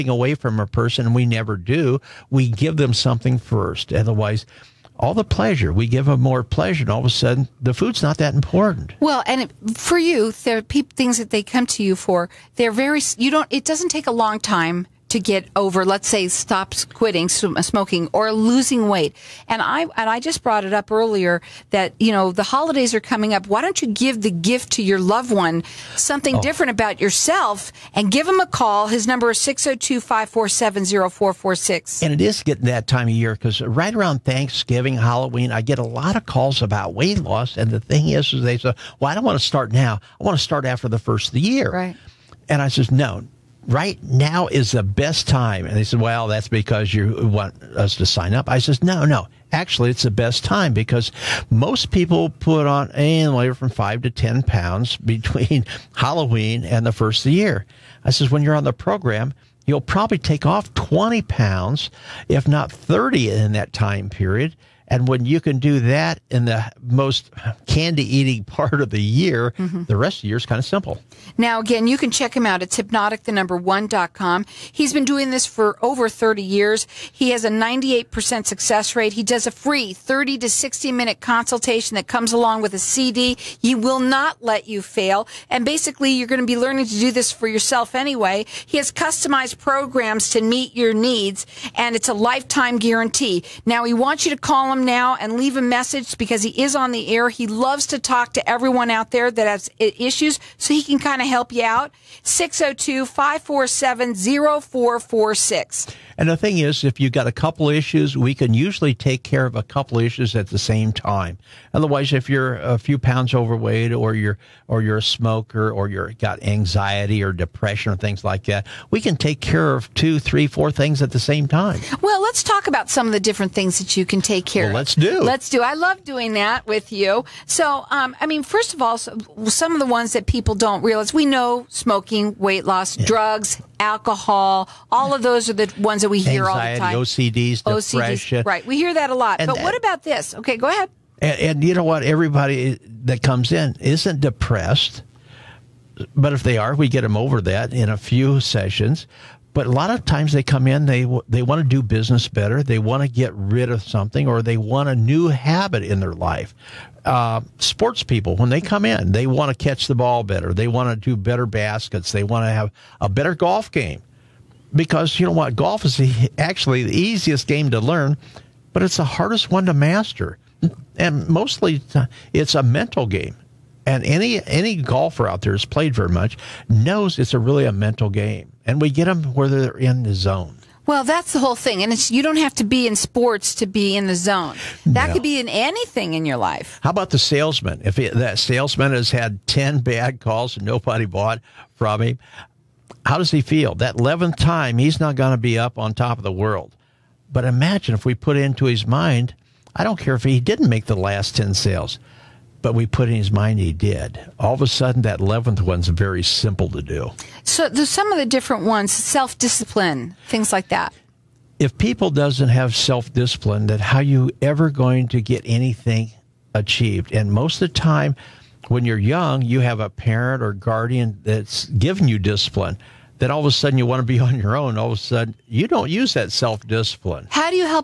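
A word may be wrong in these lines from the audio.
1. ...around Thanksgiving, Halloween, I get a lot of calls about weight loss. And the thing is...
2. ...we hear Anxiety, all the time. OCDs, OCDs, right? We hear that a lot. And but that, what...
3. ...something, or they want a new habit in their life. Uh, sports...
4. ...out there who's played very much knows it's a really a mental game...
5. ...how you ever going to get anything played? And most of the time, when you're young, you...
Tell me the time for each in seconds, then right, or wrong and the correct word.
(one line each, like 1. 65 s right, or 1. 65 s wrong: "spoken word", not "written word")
1. 33 s right
2. 136 s right
3. 153 s right
4. 175 s right
5. 213 s wrong: "achieved", not "played".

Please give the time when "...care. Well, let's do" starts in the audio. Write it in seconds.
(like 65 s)
124 s.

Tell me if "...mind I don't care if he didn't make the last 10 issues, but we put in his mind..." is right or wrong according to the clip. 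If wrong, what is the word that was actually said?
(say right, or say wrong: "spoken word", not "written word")
wrong: "sales", not "issues".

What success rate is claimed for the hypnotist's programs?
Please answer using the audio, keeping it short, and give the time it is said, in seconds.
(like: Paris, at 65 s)
98%, at 77 s.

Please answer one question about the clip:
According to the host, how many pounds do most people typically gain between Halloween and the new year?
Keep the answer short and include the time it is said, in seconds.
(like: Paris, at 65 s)
5 to 10 pounds, at 53 s.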